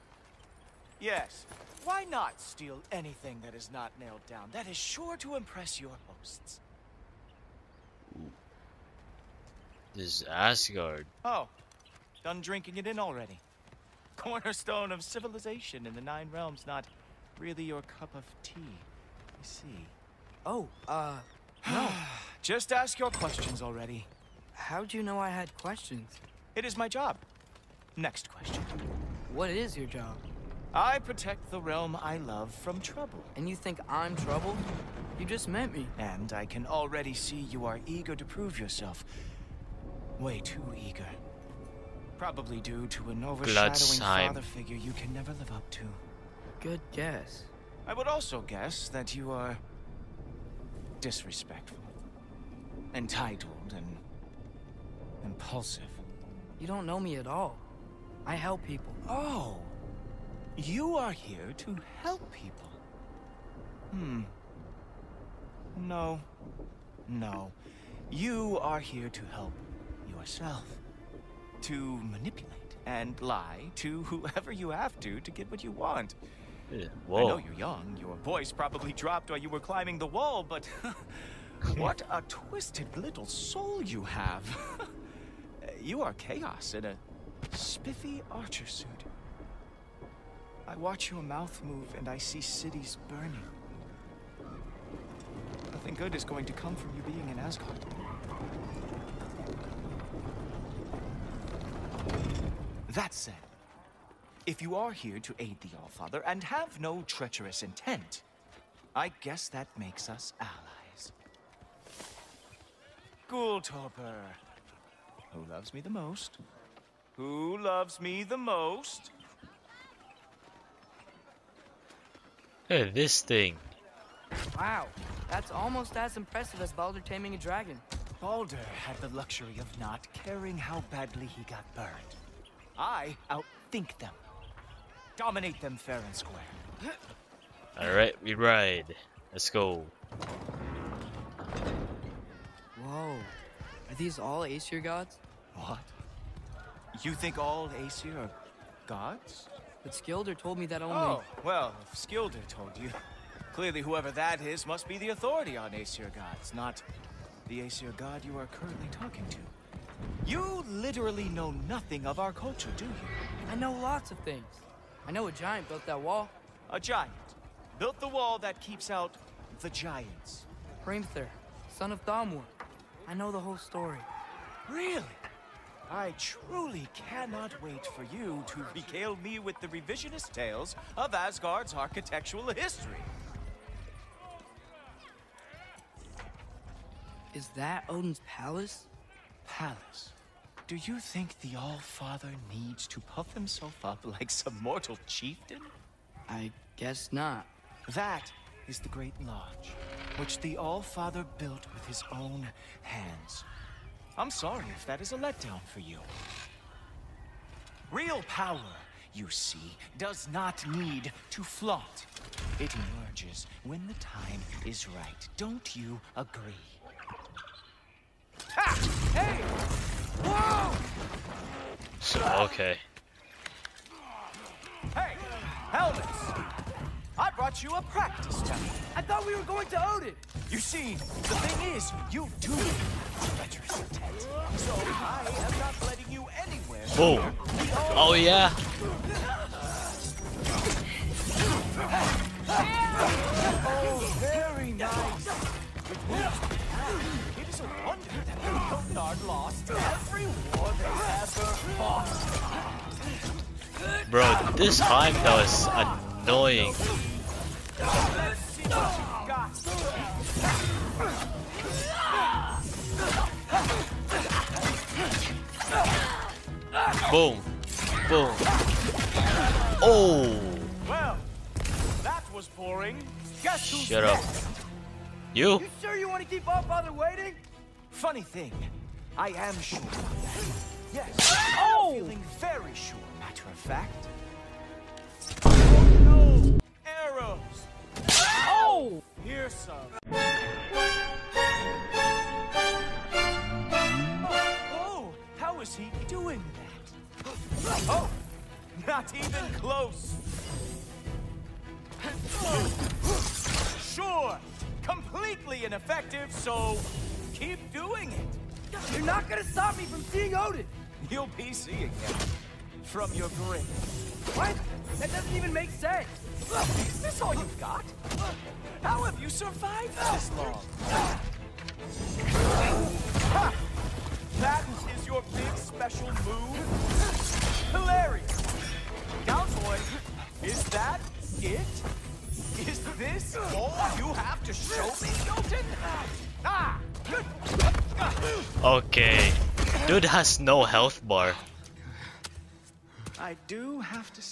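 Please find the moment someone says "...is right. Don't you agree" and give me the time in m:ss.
3:34.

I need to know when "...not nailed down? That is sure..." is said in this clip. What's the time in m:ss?
0:03.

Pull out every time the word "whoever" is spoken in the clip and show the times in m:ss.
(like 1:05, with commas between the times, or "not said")
1:14, 2:33.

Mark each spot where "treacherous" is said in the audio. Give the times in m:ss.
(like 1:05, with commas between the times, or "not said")
1:47, 3:53.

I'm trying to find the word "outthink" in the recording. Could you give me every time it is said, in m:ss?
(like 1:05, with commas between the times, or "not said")
2:13.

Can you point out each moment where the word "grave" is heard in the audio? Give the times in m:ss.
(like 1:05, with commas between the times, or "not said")
5:13.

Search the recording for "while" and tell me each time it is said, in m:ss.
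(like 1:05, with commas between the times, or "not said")
1:19.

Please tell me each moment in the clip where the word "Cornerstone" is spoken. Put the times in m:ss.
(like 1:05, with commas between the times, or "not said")
0:14.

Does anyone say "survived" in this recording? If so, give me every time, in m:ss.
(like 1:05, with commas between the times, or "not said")
5:19.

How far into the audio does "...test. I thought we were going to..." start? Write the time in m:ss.
3:48.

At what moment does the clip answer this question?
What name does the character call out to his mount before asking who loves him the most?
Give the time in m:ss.
1:53.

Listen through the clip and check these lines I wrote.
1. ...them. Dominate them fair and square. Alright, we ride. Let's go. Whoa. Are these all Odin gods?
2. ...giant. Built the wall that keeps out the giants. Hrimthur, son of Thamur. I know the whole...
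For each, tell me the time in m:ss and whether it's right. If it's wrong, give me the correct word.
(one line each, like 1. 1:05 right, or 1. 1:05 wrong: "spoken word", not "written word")
1. 2:13 wrong: "Aesir", not "Odin"
2. 2:46 right.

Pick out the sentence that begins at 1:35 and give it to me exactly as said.
Nothing good is going to come from you being in Asgard.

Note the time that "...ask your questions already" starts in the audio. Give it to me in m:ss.
0:22.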